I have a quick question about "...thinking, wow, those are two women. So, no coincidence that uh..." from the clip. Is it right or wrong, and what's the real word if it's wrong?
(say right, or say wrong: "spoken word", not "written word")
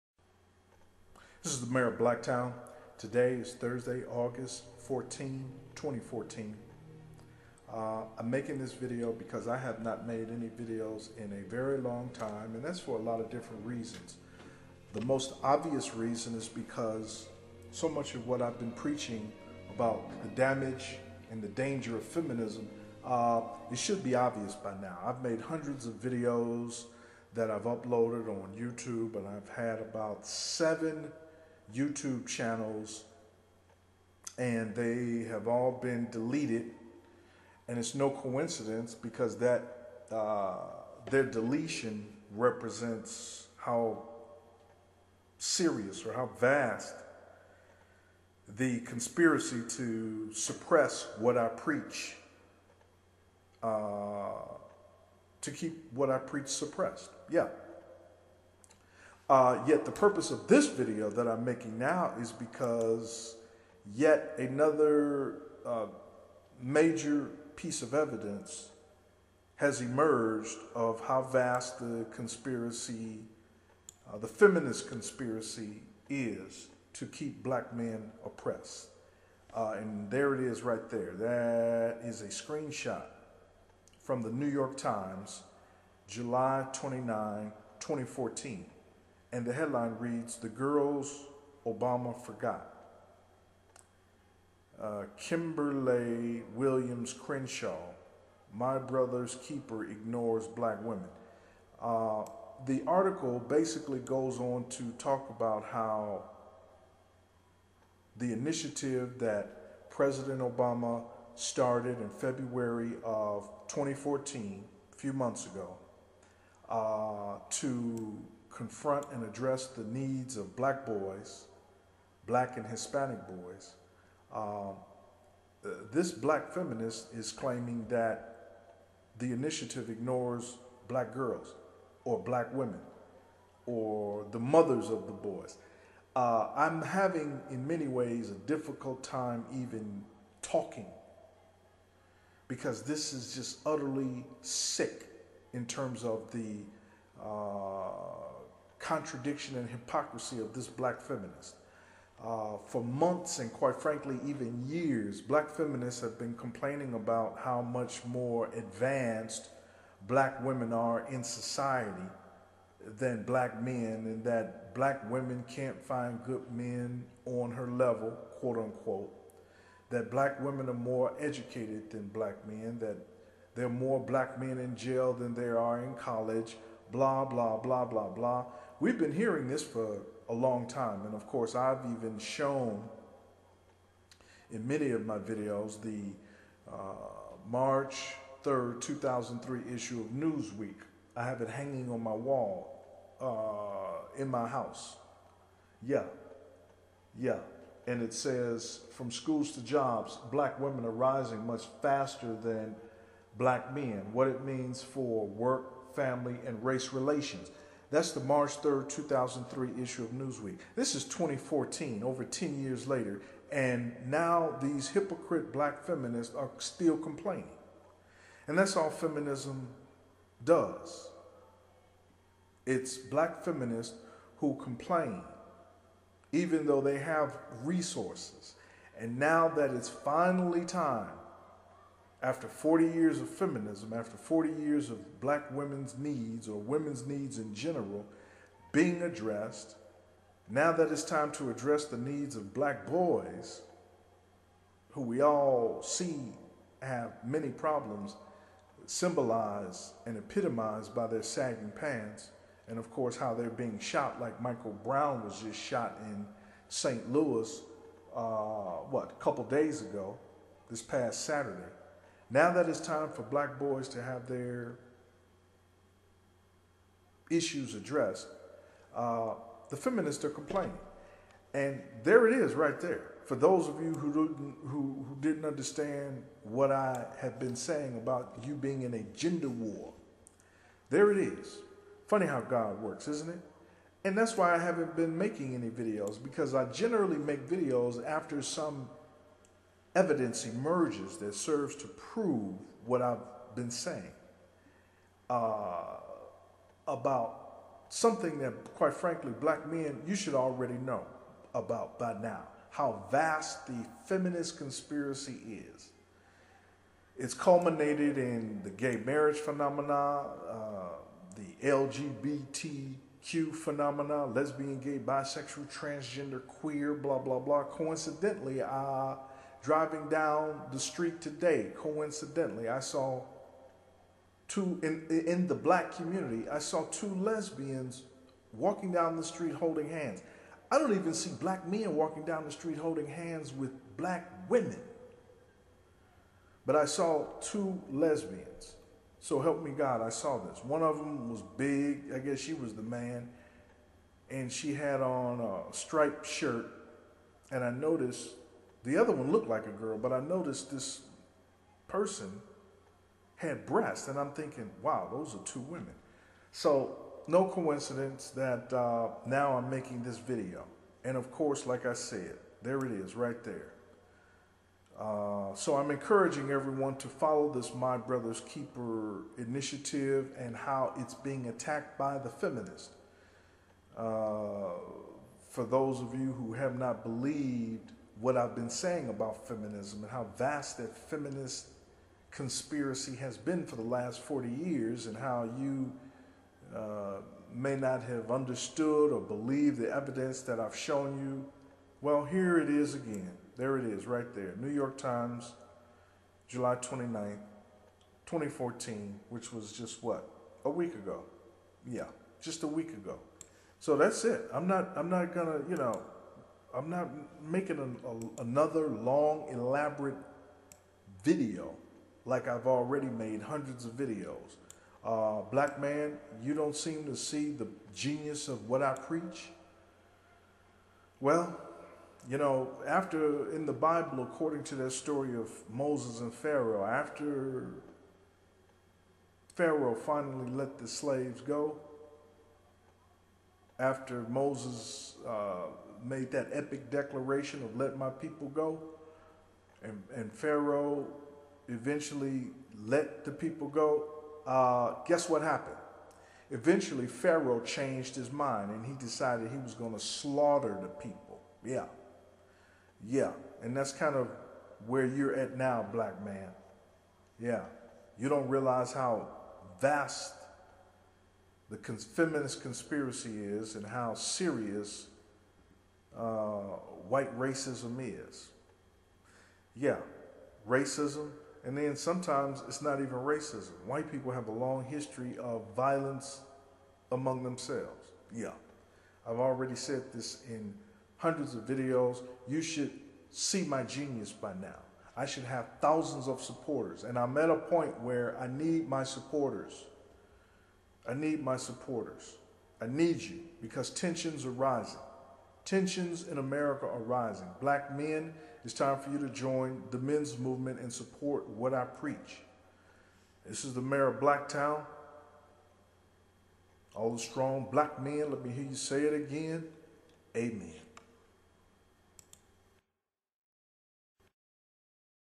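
right.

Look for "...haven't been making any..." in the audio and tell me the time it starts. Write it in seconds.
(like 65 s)
284 s.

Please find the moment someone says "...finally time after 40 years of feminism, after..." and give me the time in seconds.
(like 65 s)
229 s.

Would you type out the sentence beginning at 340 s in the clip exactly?
One of them was big, I guess she was the man, and she had on a striped shirt.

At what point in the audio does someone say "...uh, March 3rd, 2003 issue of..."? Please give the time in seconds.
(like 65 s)
186 s.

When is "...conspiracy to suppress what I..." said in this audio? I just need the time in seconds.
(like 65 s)
48 s.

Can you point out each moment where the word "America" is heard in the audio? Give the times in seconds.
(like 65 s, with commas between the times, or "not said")
496 s.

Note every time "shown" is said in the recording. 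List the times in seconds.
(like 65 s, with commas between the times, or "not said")
182 s, 390 s.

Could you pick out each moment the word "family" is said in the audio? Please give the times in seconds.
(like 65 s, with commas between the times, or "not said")
205 s.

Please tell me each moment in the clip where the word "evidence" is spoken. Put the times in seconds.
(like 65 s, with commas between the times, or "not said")
67 s, 289 s, 389 s.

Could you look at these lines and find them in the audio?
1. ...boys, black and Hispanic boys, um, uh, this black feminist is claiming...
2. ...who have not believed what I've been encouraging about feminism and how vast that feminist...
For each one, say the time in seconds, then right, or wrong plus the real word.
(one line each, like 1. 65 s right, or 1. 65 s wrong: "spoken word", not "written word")
1. 120 s right
2. 376 s wrong: "saying", not "encouraging".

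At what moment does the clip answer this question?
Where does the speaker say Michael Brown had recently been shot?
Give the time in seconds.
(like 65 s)
256 s.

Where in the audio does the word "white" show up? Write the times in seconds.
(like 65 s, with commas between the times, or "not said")
467 s, 473 s.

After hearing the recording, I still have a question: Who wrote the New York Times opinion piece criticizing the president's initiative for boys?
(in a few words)
Kimberlé Williams Crenshaw.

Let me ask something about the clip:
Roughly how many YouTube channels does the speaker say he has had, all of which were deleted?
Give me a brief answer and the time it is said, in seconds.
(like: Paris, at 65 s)
7, at 30 s.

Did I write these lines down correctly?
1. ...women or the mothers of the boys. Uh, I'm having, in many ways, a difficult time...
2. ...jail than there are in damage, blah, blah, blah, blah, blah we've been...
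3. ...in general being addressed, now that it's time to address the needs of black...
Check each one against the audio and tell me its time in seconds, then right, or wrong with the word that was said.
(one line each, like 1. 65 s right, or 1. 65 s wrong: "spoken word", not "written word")
1. 132 s right
2. 174 s wrong: "college", not "damage"
3. 237 s right.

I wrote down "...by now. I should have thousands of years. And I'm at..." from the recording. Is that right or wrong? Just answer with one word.
wrong.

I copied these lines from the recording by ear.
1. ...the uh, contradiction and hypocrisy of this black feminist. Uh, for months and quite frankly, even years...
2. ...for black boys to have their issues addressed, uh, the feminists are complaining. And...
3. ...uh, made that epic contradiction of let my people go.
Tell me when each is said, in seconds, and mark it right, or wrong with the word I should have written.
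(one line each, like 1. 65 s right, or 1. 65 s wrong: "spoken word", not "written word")
1. 146 s right
2. 263 s right
3. 435 s wrong: "declaration", not "contradiction".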